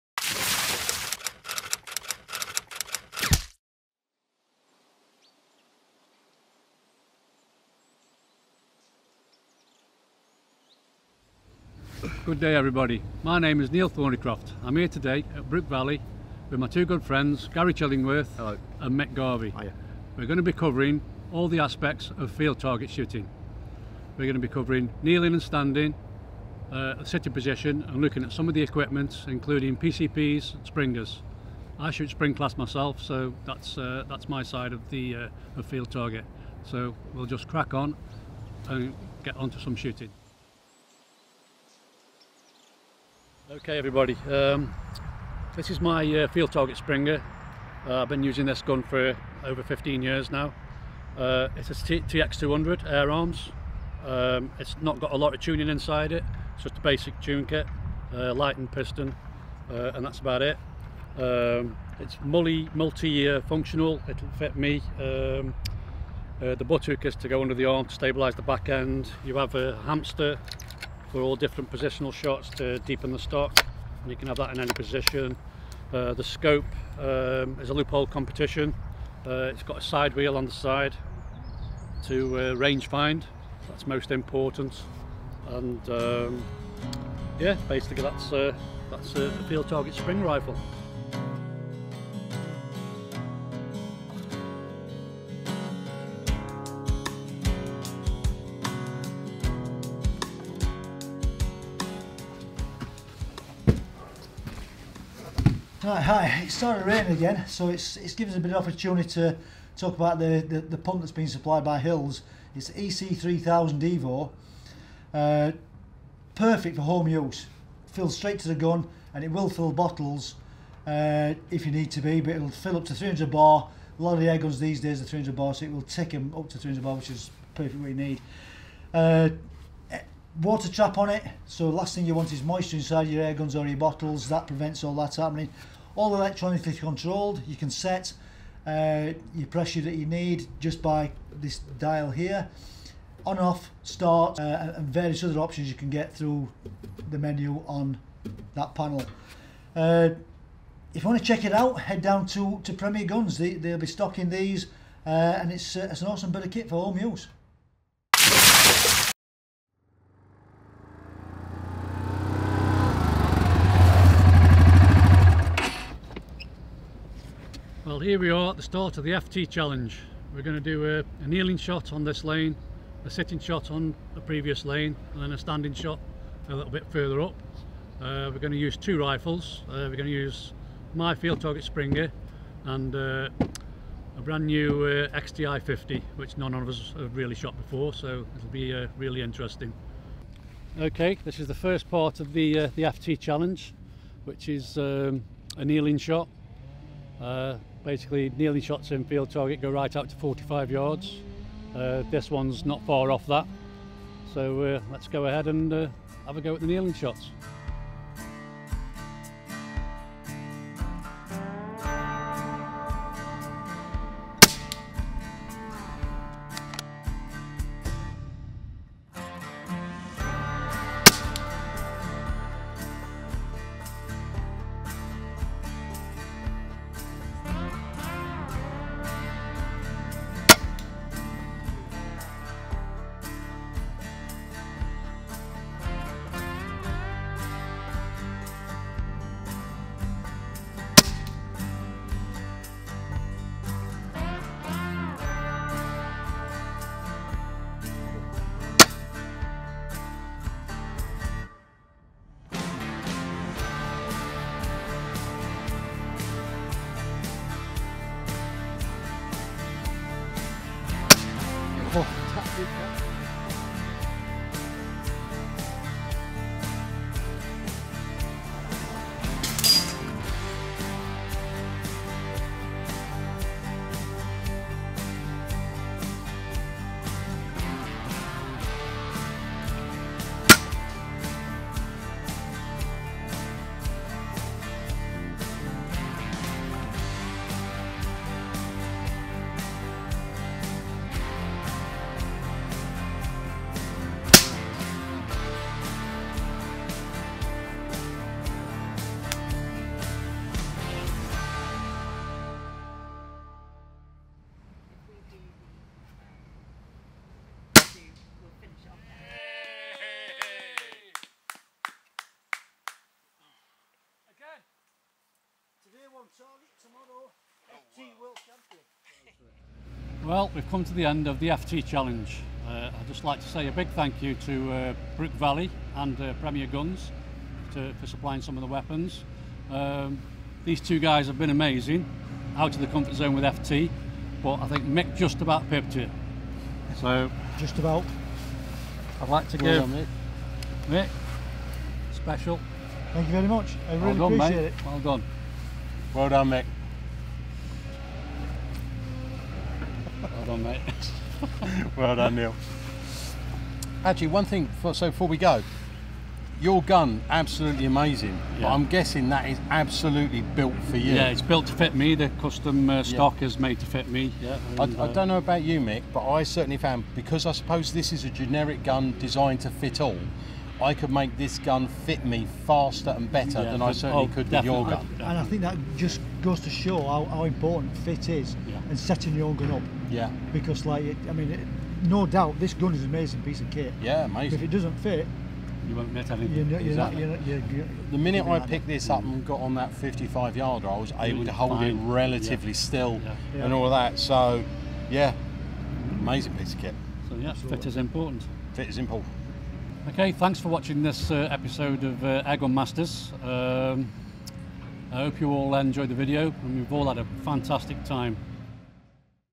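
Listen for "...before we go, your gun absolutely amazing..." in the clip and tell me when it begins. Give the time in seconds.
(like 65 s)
355 s.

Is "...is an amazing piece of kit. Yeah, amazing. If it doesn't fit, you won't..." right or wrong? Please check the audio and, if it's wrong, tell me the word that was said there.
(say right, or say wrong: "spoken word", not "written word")
right.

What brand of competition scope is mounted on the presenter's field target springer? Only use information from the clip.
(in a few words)
Leupold.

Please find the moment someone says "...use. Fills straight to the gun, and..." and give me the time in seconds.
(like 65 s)
117 s.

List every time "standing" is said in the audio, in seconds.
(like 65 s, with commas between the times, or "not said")
25 s, 175 s.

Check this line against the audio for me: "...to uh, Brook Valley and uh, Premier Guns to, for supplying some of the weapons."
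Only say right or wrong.
right.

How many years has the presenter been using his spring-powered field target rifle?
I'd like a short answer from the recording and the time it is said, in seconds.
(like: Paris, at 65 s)
15, at 49 s.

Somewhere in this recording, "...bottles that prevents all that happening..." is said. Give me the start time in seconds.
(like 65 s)
133 s.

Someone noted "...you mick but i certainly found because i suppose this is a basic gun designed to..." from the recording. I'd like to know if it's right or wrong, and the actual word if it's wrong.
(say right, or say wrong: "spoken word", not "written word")
wrong: "generic", not "basic".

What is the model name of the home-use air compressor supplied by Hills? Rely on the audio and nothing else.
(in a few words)
EC3000 Evo.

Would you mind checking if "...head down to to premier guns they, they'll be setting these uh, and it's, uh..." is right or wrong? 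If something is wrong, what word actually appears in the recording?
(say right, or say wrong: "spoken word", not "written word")
wrong: "stocking", not "setting".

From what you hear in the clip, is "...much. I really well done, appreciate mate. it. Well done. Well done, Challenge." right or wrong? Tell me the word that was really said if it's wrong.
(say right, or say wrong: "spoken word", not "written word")
wrong: "Mick", not "Challenge".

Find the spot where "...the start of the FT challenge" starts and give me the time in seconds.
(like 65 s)
168 s.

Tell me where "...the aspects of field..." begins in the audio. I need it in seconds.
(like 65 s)
21 s.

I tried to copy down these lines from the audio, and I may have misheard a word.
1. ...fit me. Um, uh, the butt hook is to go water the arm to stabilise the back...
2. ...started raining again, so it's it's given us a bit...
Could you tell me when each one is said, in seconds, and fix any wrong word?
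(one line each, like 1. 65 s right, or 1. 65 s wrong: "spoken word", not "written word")
1. 64 s wrong: "under", not "water"
2. 106 s right.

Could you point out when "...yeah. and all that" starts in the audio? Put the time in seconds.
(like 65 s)
393 s.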